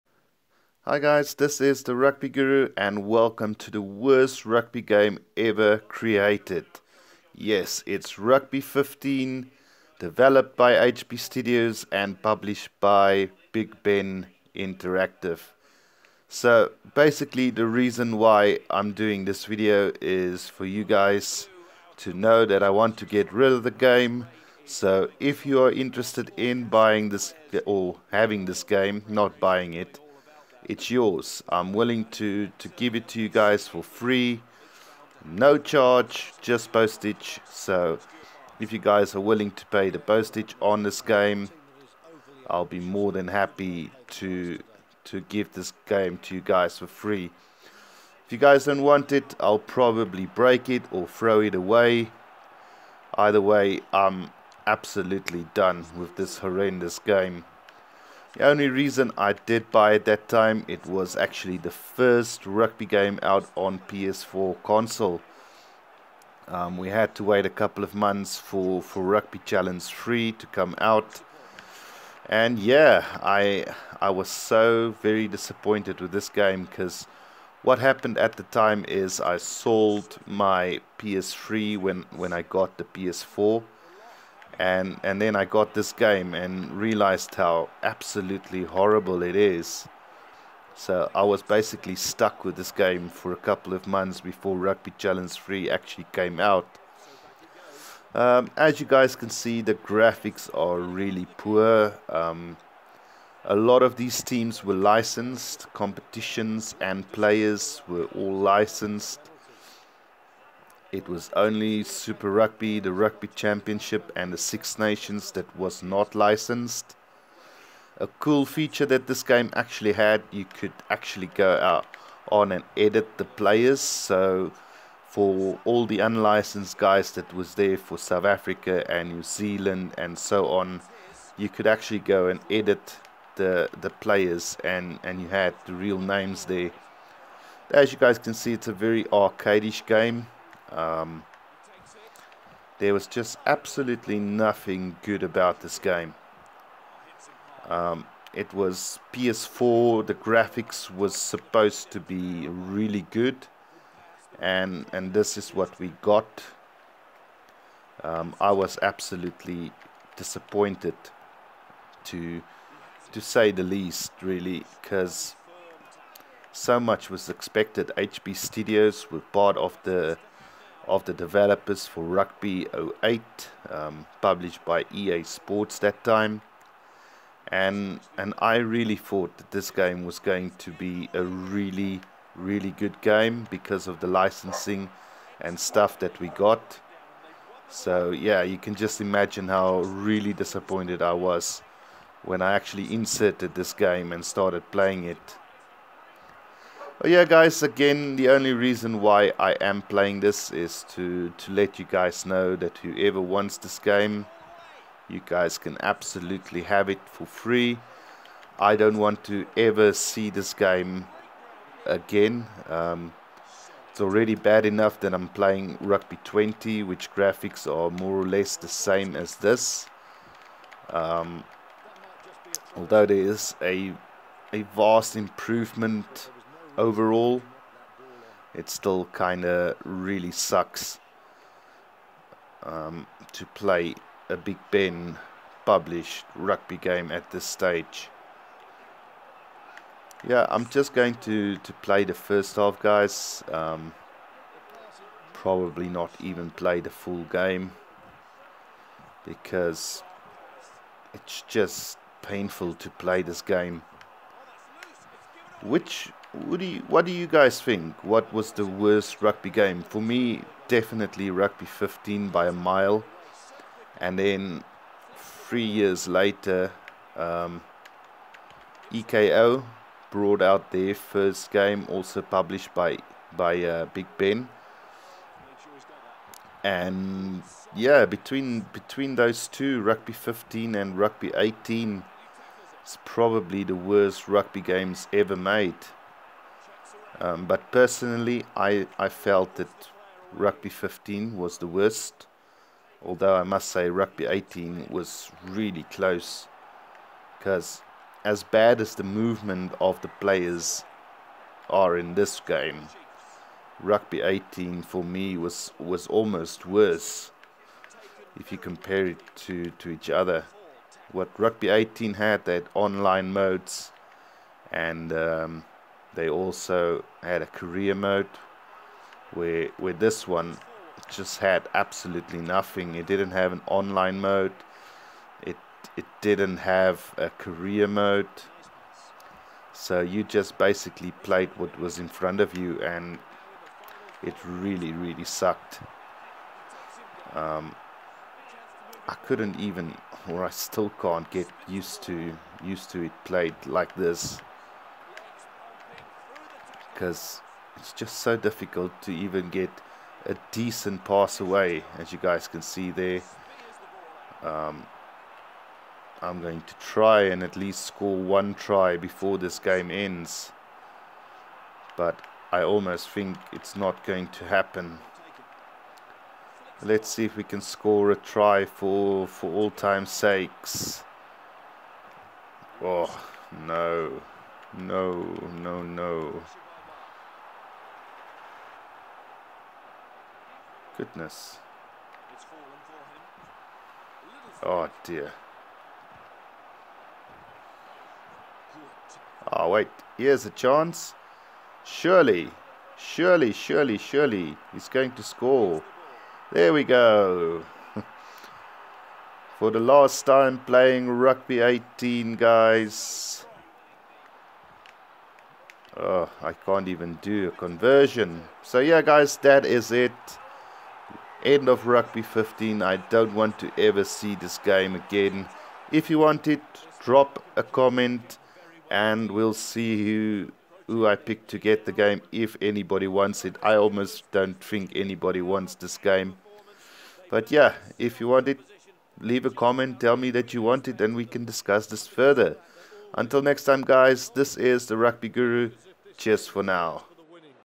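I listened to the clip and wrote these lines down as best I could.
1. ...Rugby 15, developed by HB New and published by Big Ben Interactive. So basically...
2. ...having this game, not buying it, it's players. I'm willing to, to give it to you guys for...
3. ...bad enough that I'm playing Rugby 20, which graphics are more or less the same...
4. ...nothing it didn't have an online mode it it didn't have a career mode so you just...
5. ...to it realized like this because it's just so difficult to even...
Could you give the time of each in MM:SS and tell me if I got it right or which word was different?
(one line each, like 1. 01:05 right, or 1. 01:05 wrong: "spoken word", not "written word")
1. 00:08 wrong: "Studios", not "New"
2. 00:28 wrong: "yours", not "players"
3. 03:34 right
4. 05:22 right
5. 05:42 wrong: "played", not "realized".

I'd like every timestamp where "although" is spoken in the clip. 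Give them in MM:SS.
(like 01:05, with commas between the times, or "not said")
03:42, 04:53.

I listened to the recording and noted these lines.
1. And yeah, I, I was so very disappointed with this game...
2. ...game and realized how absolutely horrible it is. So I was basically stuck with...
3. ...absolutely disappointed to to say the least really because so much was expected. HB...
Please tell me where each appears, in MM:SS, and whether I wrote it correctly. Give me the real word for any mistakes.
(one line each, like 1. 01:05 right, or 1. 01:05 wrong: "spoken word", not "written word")
1. 01:12 right
2. 01:25 right
3. 02:38 right.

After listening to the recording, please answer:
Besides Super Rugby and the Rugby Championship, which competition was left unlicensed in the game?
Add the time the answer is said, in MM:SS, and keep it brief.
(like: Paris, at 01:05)
Six Nations, at 01:54.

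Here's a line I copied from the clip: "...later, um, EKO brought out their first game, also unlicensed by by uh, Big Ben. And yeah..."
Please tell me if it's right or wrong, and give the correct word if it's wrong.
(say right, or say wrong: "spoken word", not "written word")
wrong: "published", not "unlicensed".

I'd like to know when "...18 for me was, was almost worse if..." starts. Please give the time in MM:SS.
05:04.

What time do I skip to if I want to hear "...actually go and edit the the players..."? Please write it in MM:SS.
02:11.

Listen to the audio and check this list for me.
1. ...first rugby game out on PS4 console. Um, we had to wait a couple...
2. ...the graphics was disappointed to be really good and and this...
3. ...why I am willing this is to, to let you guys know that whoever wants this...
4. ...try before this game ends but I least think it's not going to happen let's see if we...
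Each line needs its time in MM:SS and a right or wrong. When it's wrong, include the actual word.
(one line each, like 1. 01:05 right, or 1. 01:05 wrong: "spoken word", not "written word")
1. 01:01 right
2. 02:30 wrong: "supposed", not "disappointed"
3. 03:19 wrong: "playing", not "willing"
4. 05:58 wrong: "almost", not "least".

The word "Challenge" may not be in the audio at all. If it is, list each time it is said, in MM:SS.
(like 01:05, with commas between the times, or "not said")
01:09, 01:34.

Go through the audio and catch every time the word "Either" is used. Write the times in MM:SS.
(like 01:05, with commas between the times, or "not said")
00:53.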